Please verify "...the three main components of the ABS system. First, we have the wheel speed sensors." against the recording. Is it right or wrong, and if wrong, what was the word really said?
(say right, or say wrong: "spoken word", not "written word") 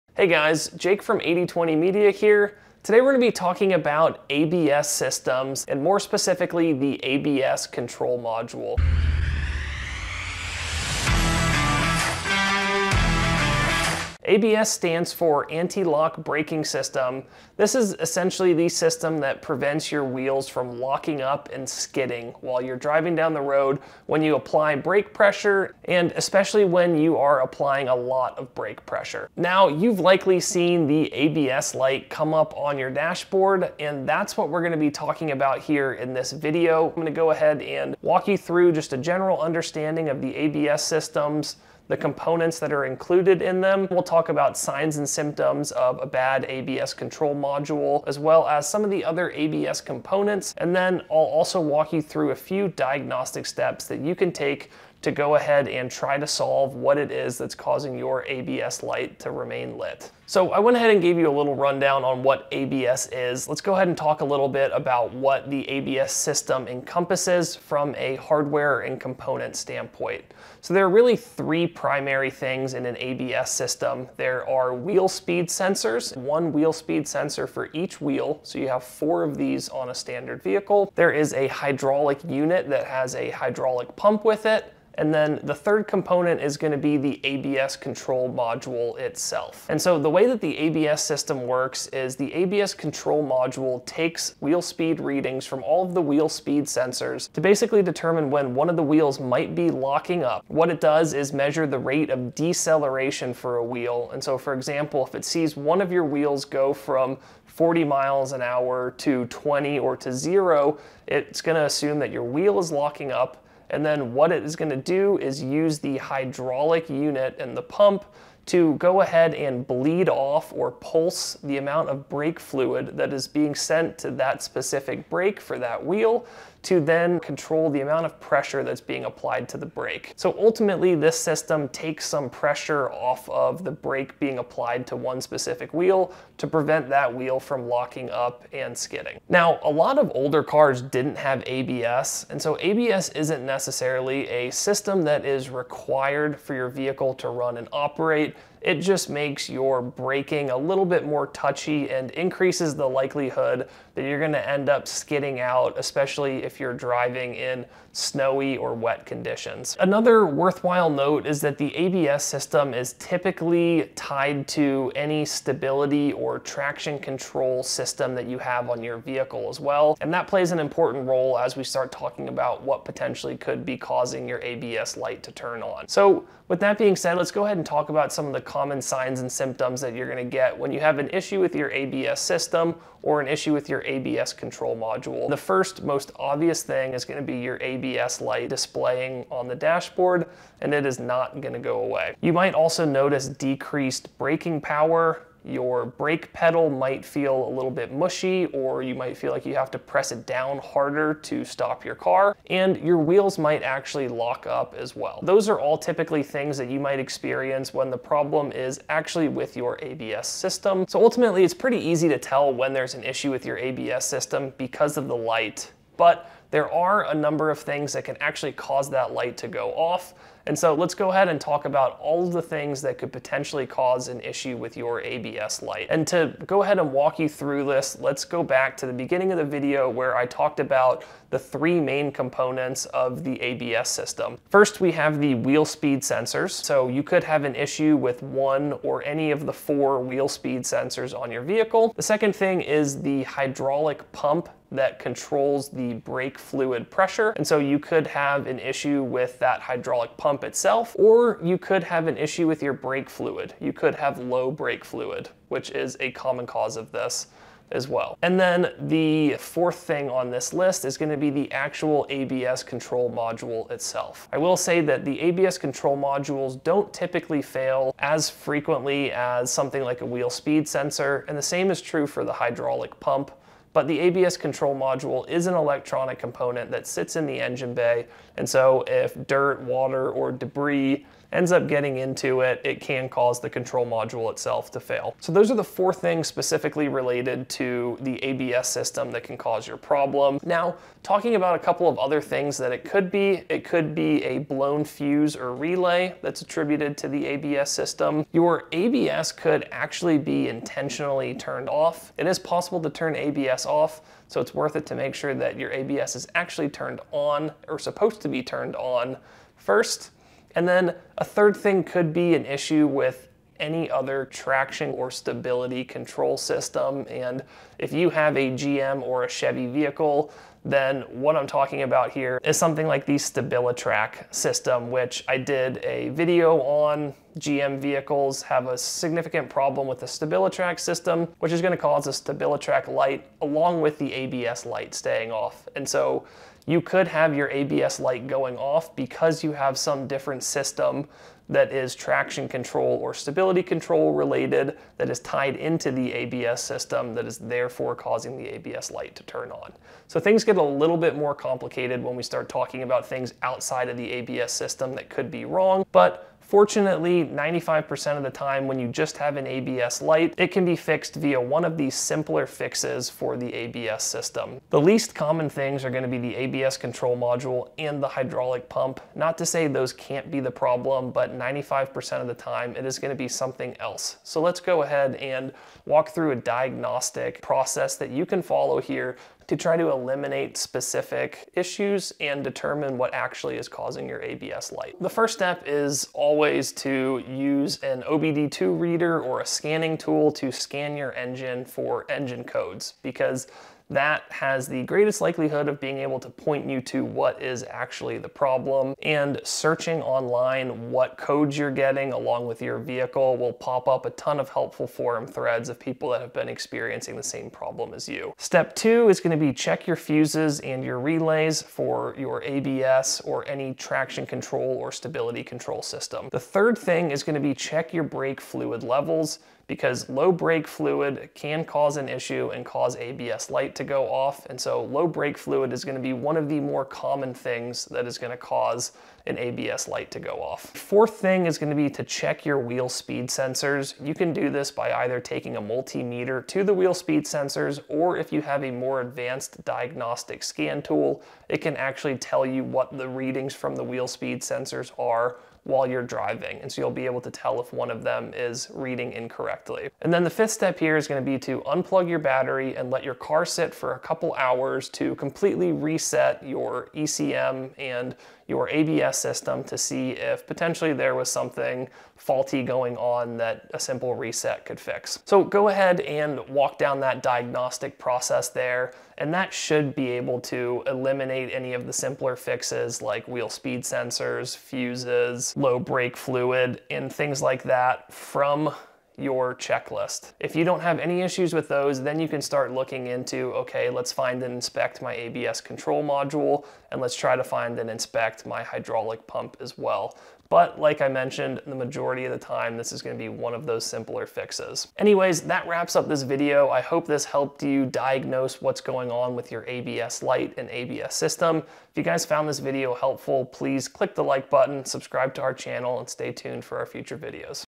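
right.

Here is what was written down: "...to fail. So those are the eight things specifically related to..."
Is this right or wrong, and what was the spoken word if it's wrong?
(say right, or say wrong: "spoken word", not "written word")
wrong: "four", not "eight".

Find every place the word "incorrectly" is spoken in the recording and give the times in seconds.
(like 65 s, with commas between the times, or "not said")
449 s.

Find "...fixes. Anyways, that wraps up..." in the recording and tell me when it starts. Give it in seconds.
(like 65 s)
494 s.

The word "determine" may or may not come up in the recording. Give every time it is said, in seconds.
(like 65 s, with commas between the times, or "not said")
97 s, 382 s.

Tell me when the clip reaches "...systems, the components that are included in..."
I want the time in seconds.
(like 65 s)
40 s.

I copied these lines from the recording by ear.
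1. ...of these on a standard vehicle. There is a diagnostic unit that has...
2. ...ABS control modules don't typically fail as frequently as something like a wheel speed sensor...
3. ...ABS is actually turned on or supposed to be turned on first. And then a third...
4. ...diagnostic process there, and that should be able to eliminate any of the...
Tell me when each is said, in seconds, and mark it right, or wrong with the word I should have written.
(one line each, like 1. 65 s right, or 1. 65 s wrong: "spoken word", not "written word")
1. 79 s wrong: "hydraulic", not "diagnostic"
2. 265 s right
3. 305 s right
4. 467 s right.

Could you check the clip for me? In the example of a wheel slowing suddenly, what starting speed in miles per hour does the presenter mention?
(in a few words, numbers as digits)
40.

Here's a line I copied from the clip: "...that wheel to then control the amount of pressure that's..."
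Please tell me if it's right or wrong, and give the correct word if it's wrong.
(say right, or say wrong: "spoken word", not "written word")
right.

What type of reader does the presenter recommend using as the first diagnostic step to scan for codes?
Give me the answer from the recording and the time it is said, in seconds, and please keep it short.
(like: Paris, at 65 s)
OBD2 reader, at 388 s.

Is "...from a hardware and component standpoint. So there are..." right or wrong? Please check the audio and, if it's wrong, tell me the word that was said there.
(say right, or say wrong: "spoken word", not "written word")
right.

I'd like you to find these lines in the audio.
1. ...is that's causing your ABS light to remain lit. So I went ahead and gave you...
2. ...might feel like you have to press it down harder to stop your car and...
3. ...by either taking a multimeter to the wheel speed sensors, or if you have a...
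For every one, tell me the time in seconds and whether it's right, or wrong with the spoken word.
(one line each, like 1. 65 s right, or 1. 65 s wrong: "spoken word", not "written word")
1. 57 s right
2. 198 s right
3. 434 s right.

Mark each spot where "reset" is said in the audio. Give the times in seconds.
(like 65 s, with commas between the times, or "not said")
455 s, 464 s.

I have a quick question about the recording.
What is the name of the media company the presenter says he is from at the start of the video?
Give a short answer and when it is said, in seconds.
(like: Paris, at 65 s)
8020 Media, at 1 s.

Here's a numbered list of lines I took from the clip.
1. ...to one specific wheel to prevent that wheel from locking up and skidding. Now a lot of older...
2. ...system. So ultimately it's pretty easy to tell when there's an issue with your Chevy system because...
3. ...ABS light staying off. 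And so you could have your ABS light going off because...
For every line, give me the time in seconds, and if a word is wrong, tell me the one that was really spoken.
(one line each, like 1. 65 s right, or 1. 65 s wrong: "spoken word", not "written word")
1. 134 s right
2. 210 s wrong: "ABS", not "Chevy"
3. 334 s right.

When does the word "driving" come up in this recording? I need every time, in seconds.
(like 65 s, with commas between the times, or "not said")
22 s, 156 s, 446 s.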